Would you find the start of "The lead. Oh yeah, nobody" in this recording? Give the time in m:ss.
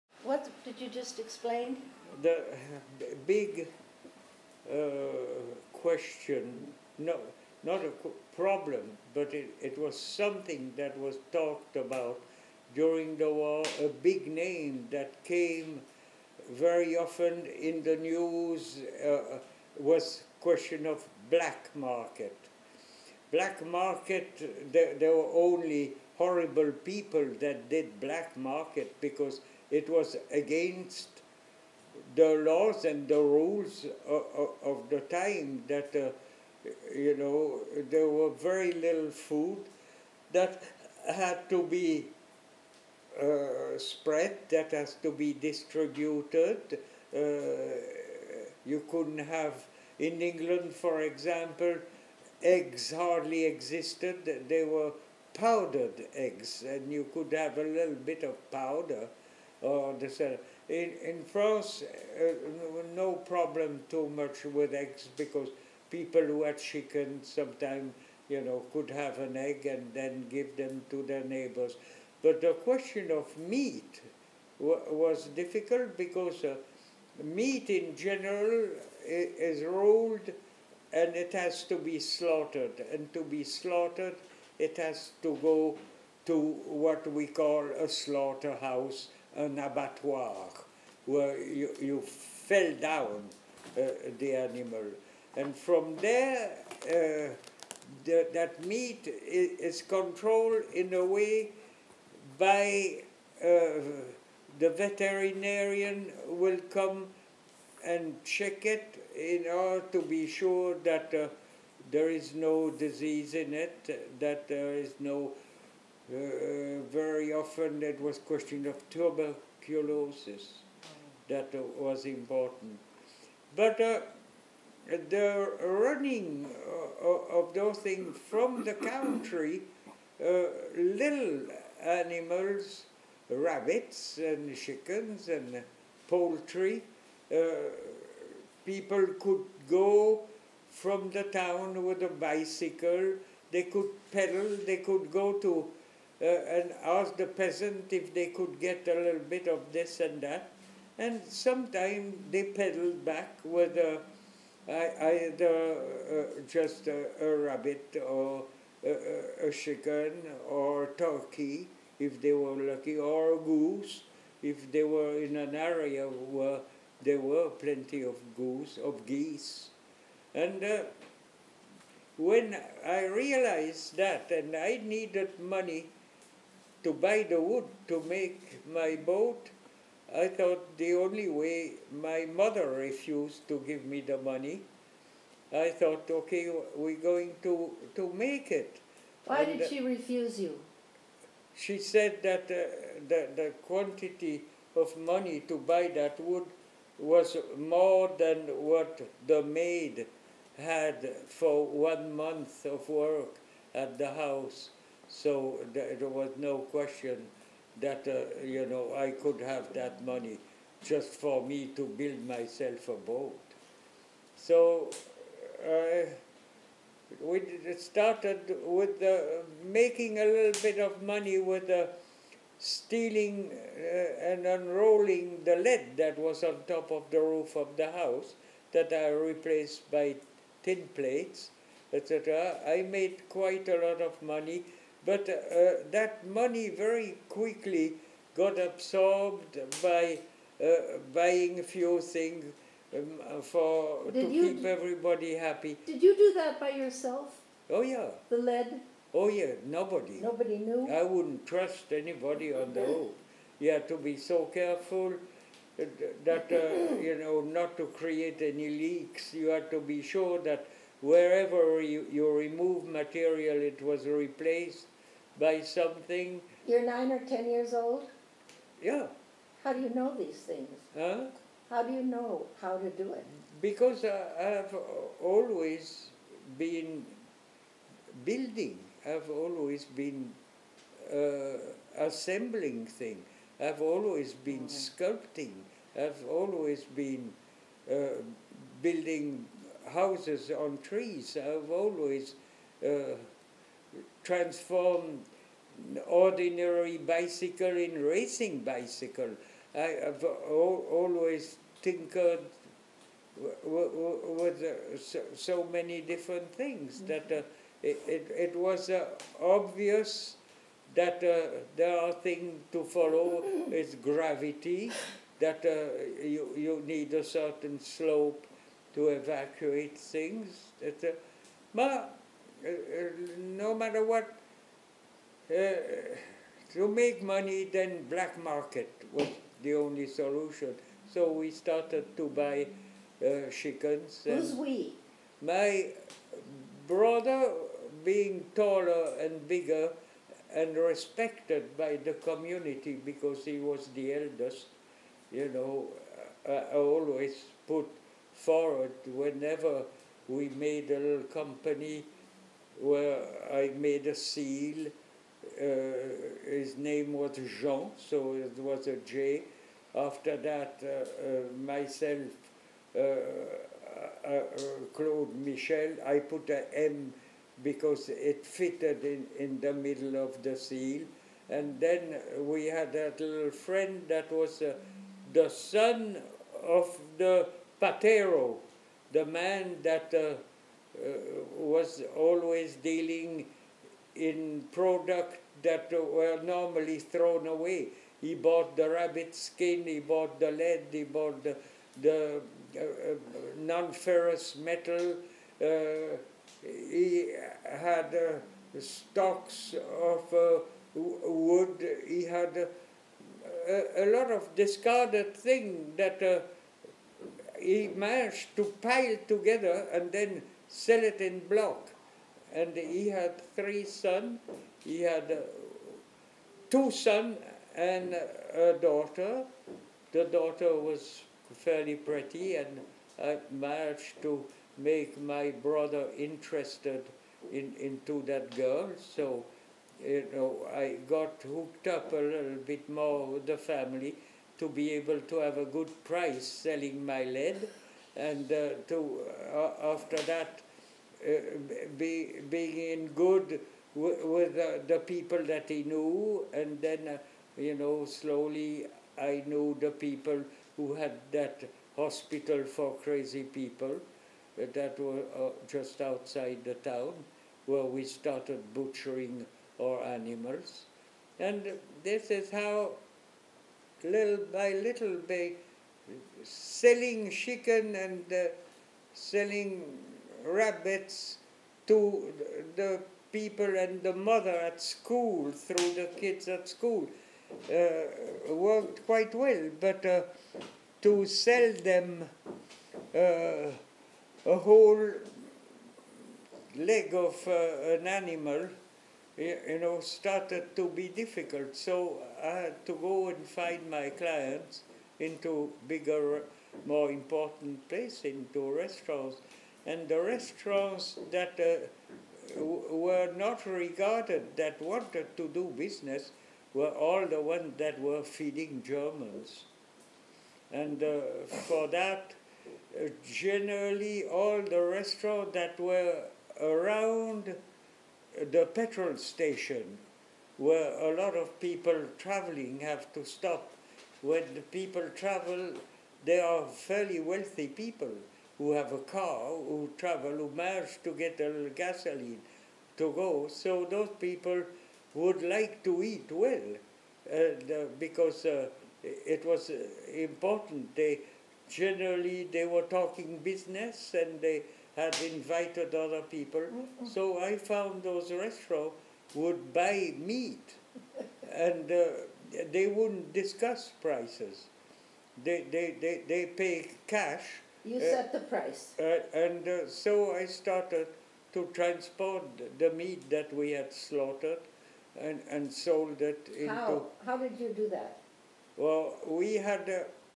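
4:08.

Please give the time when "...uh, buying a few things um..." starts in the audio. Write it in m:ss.
4:00.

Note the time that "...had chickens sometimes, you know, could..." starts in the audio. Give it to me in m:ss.
1:06.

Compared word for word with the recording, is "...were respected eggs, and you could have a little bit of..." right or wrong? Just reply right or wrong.
wrong.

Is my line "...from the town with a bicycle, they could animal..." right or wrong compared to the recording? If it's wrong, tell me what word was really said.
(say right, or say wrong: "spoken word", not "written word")
wrong: "pedal", not "animal".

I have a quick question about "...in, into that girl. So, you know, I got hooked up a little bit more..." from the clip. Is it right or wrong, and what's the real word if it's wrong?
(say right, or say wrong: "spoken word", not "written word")
right.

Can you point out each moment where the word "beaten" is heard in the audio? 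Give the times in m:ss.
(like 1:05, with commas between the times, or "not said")
not said.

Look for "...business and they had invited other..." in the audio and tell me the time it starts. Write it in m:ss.
9:03.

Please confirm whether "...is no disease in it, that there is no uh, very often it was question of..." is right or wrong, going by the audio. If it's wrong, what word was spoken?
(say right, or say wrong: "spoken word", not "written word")
right.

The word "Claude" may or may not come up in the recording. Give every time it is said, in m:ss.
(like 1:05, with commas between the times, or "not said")
6:04.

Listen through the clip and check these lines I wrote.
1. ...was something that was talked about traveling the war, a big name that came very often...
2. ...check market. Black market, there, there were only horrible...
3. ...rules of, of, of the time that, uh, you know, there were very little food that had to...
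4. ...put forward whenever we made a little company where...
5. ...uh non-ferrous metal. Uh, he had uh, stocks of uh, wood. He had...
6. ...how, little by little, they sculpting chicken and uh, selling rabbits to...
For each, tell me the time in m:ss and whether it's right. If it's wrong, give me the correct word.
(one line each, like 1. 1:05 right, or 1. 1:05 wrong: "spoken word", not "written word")
1. 0:09 wrong: "during", not "traveling"
2. 0:21 wrong: "black", not "check"
3. 0:33 right
4. 5:47 right
5. 6:32 right
6. 7:42 wrong: "selling", not "sculpting".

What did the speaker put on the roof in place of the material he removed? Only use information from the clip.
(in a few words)
Tin plates.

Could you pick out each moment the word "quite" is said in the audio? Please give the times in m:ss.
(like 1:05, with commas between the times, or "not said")
3:53, 7:59.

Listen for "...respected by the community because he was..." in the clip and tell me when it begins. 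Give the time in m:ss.
5:40.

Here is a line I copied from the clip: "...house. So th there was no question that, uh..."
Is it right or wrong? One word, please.
right.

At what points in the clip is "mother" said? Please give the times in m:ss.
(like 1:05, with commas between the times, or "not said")
3:02, 7:54.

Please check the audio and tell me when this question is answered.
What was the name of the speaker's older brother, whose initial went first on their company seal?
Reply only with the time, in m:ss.
5:57.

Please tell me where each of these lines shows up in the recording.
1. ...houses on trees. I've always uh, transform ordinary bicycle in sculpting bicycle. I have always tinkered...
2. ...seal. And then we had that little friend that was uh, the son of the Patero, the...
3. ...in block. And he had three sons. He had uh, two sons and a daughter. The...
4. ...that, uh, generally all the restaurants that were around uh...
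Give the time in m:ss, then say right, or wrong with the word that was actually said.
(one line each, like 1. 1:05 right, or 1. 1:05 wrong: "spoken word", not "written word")
1. 4:49 wrong: "racing", not "sculpting"
2. 6:10 right
3. 6:51 right
4. 8:31 right.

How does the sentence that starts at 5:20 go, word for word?
That, but no matter what, uh, to make money, then black market was the only solution.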